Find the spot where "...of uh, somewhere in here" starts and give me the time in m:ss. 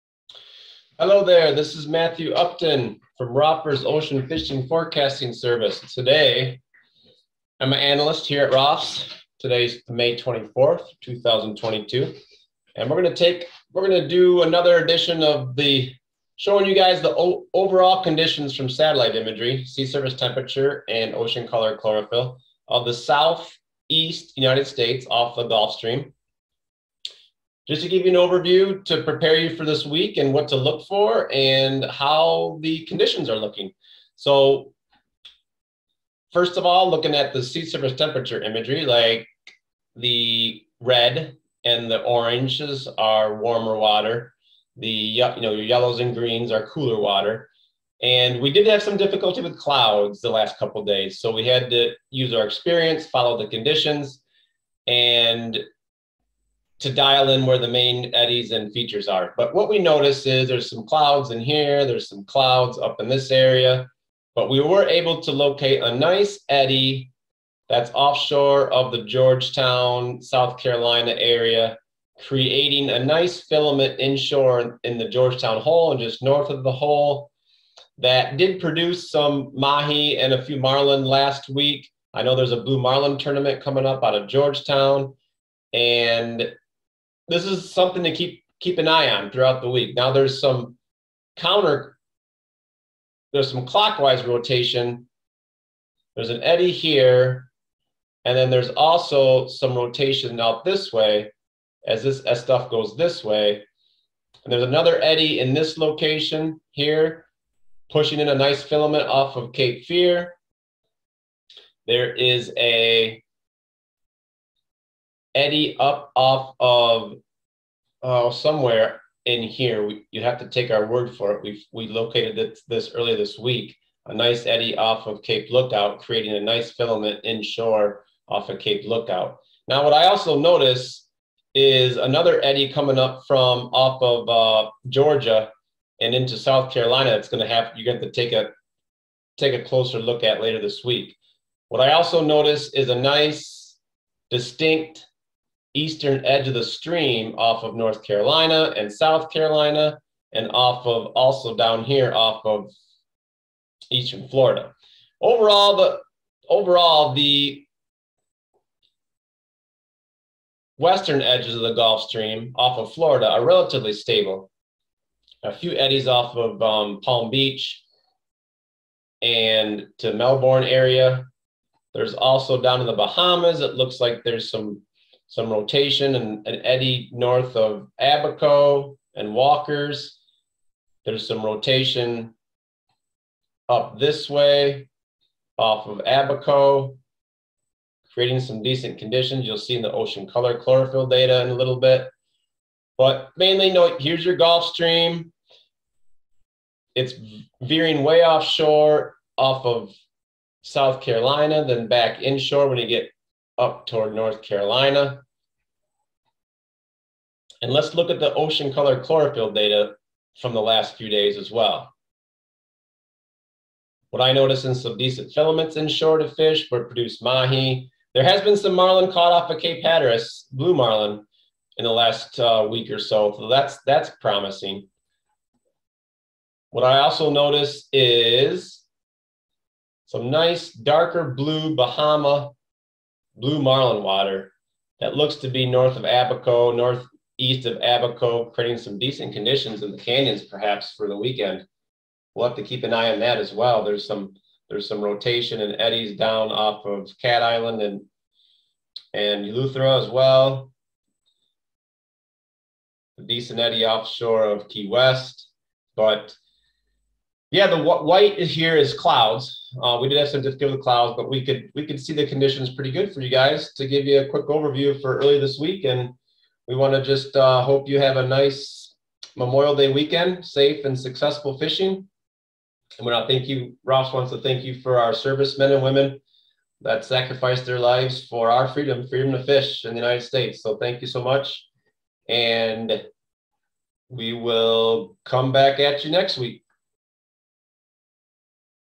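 1:56.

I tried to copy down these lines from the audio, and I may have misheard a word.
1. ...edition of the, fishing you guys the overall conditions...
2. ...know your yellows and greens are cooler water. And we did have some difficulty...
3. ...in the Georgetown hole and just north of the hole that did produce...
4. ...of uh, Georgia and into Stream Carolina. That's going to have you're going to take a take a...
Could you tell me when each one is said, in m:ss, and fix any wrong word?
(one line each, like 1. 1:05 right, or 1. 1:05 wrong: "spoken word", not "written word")
1. 0:14 wrong: "showing", not "fishing"
2. 0:45 right
3. 1:14 right
4. 2:14 wrong: "South", not "Stream".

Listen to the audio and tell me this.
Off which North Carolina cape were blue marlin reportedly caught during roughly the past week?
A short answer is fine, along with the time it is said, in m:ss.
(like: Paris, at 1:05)
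Cape Hatteras, at 3:39.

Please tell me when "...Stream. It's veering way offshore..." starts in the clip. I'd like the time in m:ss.
3:14.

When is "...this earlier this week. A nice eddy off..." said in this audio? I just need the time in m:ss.
2:02.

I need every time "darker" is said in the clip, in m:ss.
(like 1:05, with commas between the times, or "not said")
3:50.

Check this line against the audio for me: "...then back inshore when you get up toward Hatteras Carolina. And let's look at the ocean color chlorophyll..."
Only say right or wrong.
wrong.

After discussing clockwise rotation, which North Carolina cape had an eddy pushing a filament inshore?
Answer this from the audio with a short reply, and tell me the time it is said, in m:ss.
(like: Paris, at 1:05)
Cape Fear, at 1:49.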